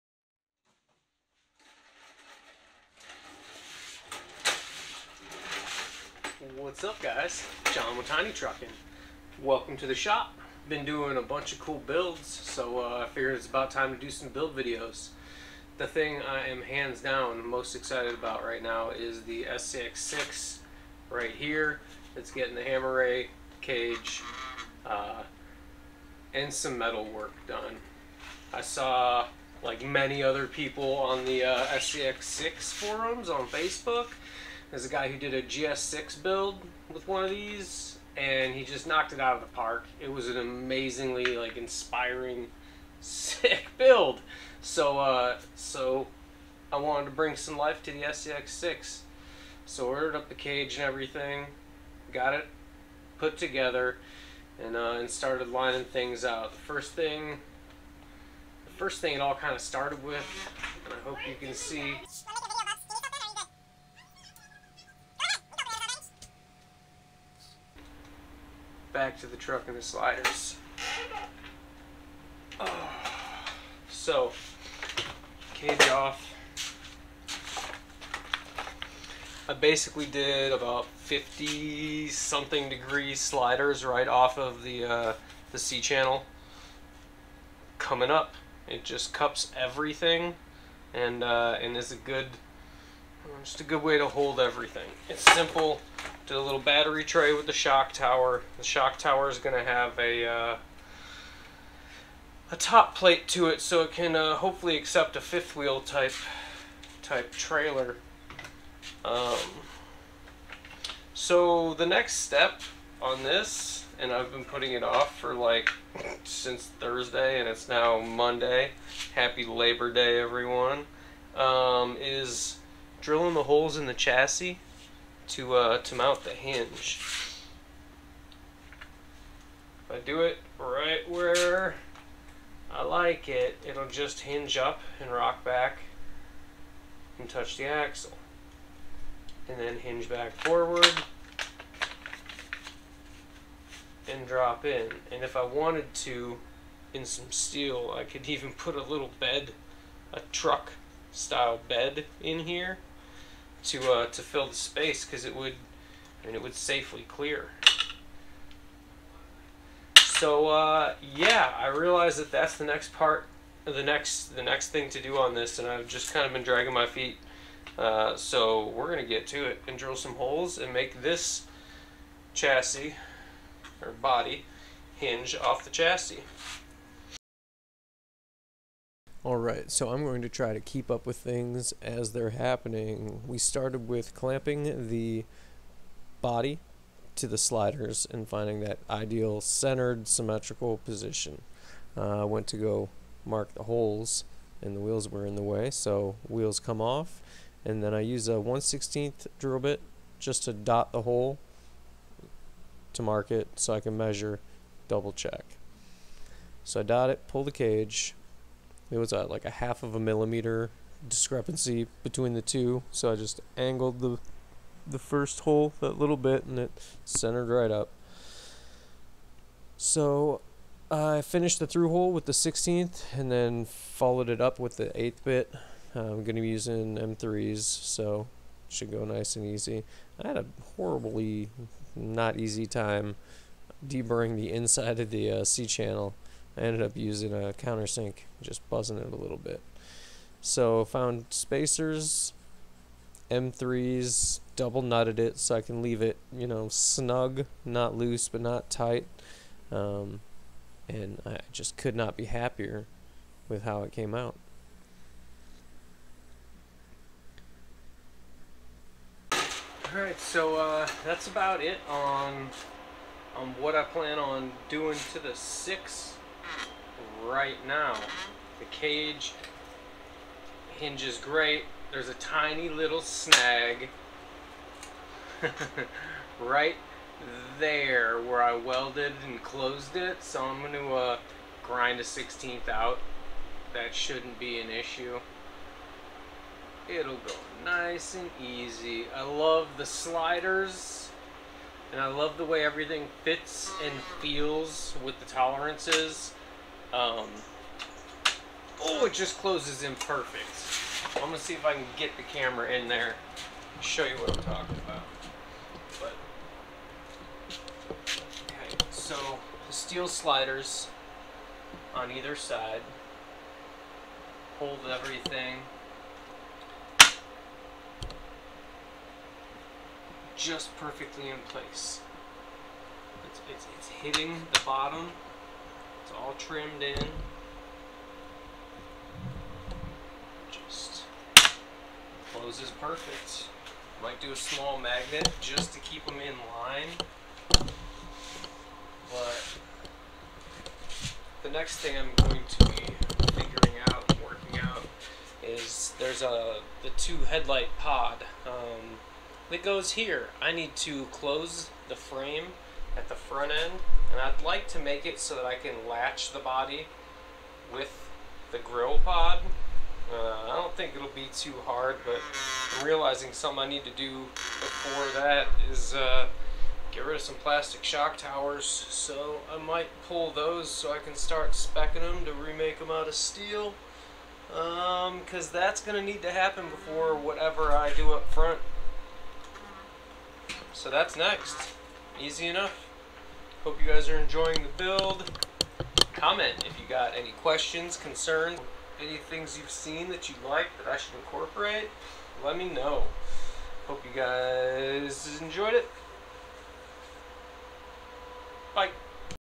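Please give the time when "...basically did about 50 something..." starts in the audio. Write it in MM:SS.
01:19.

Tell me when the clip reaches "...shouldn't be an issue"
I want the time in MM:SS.
04:43.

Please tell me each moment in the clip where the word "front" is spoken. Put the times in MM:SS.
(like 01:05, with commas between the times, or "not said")
05:53, 06:18.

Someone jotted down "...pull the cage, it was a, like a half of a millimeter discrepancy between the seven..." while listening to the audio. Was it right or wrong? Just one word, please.
wrong.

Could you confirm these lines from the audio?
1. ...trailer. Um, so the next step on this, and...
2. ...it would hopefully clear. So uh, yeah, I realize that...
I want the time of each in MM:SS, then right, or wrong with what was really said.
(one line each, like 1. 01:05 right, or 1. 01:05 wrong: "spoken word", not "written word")
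1. 01:47 right
2. 02:36 wrong: "safely", not "hopefully".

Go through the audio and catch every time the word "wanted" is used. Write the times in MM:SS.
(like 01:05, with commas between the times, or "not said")
00:46, 02:25.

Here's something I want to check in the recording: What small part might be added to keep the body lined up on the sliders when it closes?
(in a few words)
magnet.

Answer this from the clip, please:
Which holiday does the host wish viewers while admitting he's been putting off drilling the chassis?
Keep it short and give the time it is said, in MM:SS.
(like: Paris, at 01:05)
Labor Day, at 01:59.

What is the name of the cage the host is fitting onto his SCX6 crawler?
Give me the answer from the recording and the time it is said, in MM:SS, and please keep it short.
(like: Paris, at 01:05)
Hammer Rey, at 00:22.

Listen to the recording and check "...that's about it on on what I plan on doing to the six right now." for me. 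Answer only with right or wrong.
right.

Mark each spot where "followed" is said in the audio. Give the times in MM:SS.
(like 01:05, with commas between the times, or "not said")
03:43.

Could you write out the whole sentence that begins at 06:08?
So I might pull those so I can start specking them to remake them out of steel.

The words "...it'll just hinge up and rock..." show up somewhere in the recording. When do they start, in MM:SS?
02:13.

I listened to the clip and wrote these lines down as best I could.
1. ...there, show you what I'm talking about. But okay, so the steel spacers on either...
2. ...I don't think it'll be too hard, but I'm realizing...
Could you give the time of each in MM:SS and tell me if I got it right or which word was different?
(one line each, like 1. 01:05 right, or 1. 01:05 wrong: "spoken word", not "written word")
1. 05:02 wrong: "sliders", not "spacers"
2. 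06:00 right.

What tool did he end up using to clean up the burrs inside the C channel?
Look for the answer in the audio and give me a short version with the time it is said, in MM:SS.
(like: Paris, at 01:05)
countersink, at 03:57.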